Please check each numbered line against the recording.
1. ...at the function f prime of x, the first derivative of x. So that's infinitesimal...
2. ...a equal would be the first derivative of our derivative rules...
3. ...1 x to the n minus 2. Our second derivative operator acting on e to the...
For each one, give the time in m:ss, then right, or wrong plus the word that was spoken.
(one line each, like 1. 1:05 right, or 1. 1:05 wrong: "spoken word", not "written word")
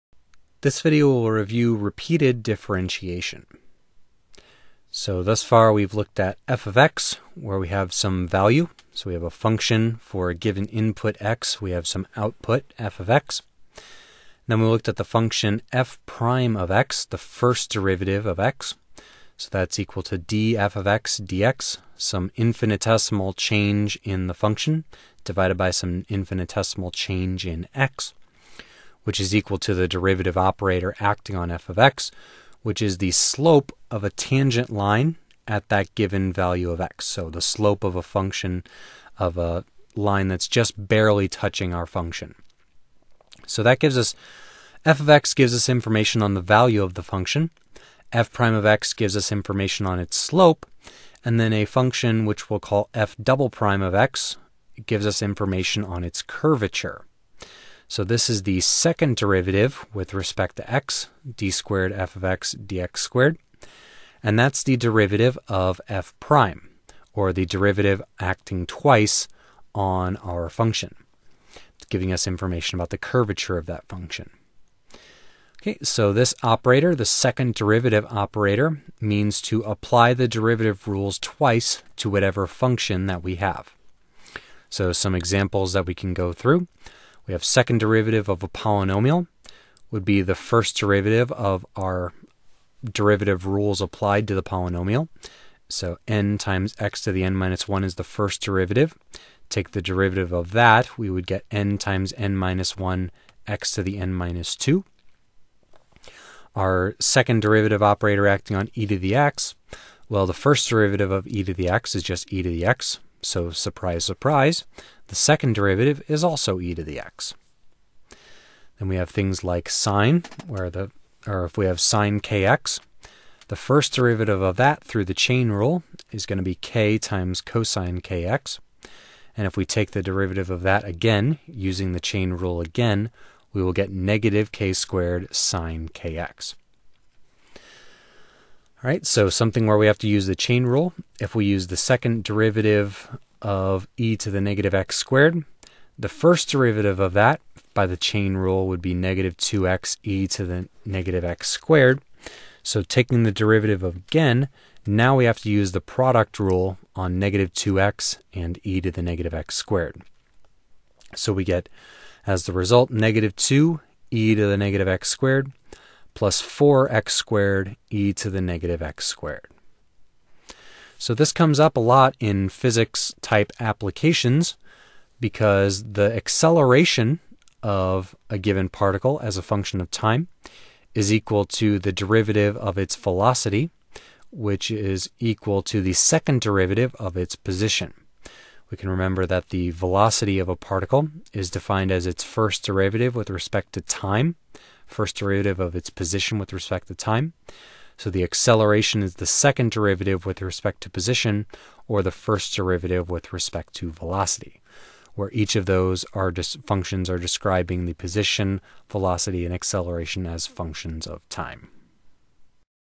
1. 0:14 wrong: "equal", not "infinitesimal"
2. 1:28 wrong: "polynomial", not "equal"
3. 1:42 right.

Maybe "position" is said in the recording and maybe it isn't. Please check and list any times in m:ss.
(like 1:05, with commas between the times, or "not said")
3:07, 3:15, 3:20, 3:27.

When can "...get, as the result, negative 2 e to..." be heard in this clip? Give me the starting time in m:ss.
2:41.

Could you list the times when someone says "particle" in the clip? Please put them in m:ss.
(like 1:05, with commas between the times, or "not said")
2:58, 3:10.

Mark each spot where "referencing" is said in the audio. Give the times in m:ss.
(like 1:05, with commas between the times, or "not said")
not said.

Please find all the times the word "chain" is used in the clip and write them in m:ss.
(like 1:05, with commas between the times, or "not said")
2:05, 2:11, 2:20, 2:27.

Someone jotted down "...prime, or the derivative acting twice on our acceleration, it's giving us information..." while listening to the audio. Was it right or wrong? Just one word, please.
wrong.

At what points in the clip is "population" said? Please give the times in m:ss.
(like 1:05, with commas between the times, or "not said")
not said.